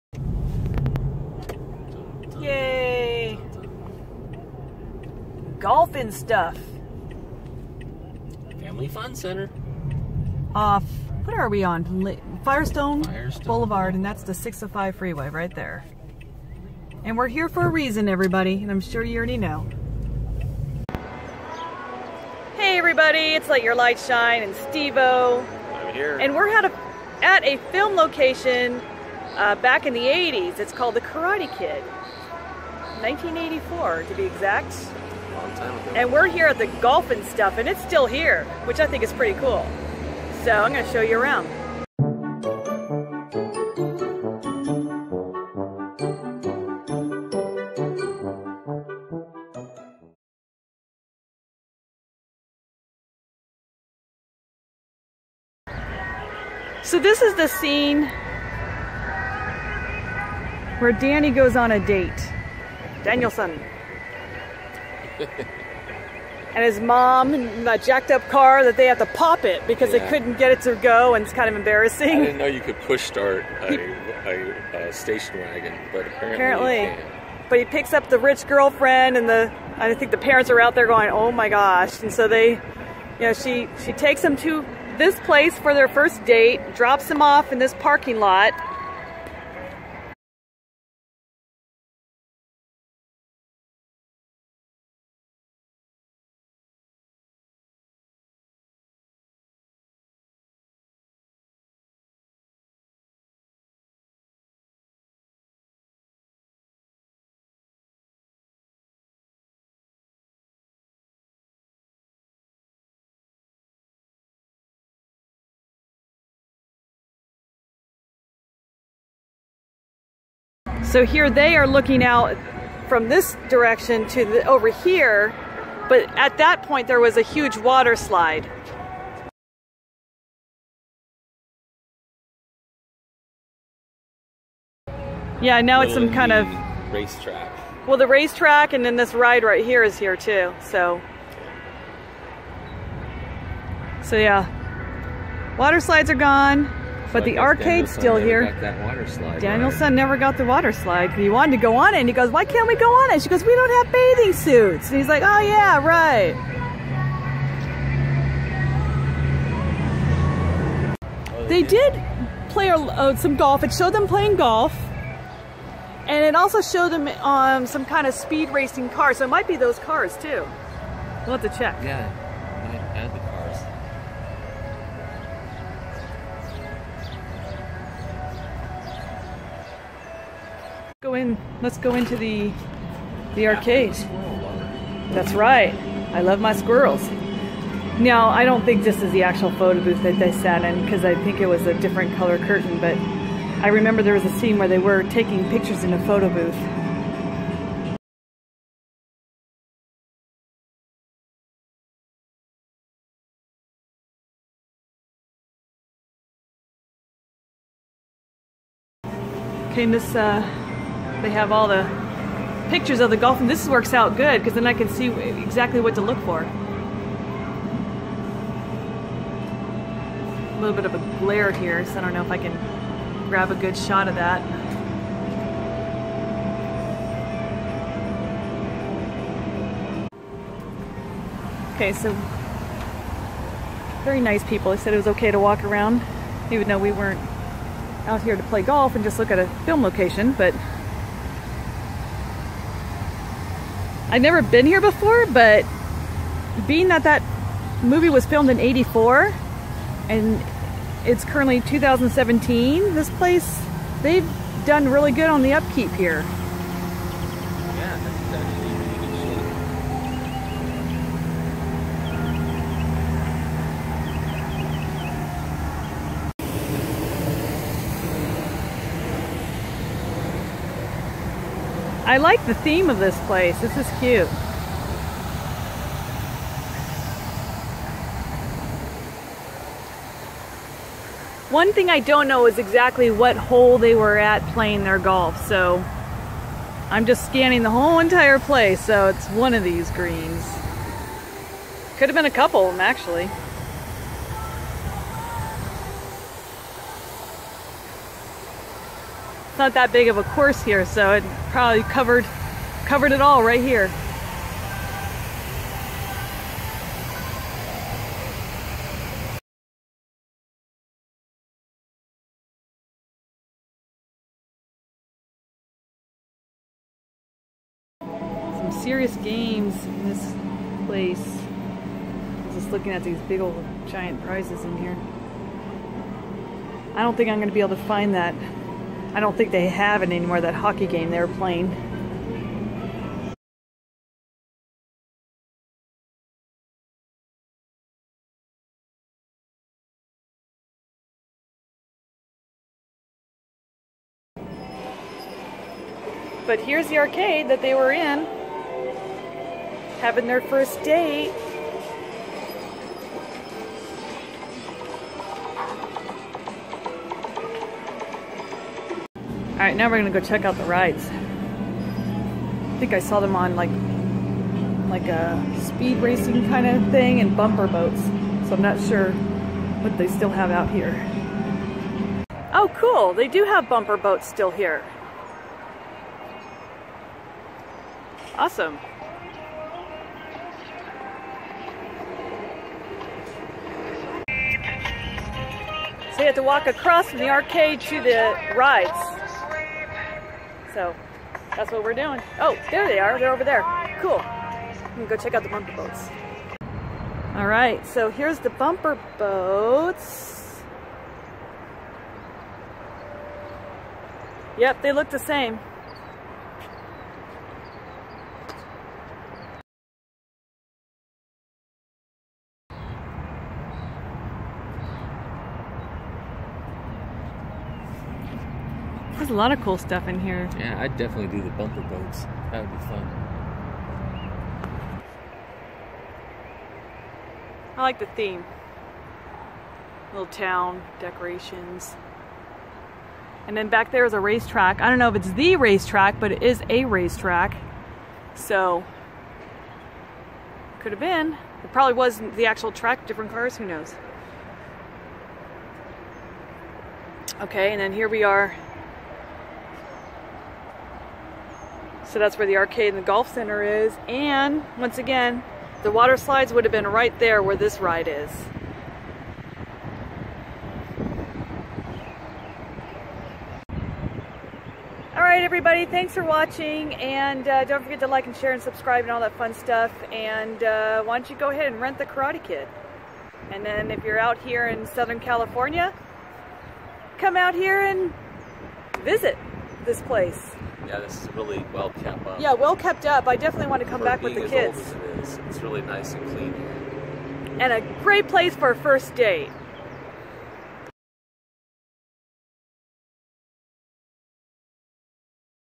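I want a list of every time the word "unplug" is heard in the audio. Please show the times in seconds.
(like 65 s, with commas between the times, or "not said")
not said.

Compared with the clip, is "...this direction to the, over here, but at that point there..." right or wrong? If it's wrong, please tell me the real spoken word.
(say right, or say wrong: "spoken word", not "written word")
right.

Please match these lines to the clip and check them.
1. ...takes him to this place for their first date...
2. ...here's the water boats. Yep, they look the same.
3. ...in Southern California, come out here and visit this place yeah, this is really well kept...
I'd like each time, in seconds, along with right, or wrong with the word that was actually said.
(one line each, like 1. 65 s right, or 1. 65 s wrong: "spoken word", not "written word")
1. 83 s right
2. 398 s wrong: "bumper", not "water"
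3. 474 s right.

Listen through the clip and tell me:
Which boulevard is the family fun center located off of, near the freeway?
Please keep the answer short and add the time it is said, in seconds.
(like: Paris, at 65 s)
Firestone Boulevard, at 13 s.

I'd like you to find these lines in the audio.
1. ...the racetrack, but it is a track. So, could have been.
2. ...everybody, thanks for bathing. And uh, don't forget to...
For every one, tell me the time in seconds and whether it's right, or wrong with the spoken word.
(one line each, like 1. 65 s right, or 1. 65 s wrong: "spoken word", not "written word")
1. 435 s wrong: "racetrack", not "track"
2. 465 s wrong: "watching", not "bathing".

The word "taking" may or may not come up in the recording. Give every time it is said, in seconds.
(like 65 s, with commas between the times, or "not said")
195 s.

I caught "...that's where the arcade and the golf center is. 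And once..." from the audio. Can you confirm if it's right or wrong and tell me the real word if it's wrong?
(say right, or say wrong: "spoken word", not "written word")
right.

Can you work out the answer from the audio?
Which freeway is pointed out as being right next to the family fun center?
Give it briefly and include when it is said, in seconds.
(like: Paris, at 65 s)
605, at 14 s.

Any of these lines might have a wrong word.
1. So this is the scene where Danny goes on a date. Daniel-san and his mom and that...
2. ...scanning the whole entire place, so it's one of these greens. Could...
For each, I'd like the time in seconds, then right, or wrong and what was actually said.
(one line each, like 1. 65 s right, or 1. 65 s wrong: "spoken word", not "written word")
1. 56 s right
2. 287 s right.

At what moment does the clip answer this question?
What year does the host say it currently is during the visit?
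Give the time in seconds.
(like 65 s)
251 s.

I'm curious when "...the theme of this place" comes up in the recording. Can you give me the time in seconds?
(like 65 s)
272 s.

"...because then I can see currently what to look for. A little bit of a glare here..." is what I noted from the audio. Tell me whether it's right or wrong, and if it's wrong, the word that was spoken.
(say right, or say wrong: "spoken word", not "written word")
wrong: "exactly", not "currently".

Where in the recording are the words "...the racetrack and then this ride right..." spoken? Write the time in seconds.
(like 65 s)
137 s.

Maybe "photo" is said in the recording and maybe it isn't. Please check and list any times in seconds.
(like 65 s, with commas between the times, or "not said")
189 s, 196 s.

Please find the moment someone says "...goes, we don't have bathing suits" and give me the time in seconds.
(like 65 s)
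153 s.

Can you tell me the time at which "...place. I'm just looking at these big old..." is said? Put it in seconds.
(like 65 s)
320 s.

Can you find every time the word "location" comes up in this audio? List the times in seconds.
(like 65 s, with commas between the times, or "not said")
27 s, 239 s.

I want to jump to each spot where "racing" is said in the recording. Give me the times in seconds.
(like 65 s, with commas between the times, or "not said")
168 s, 365 s.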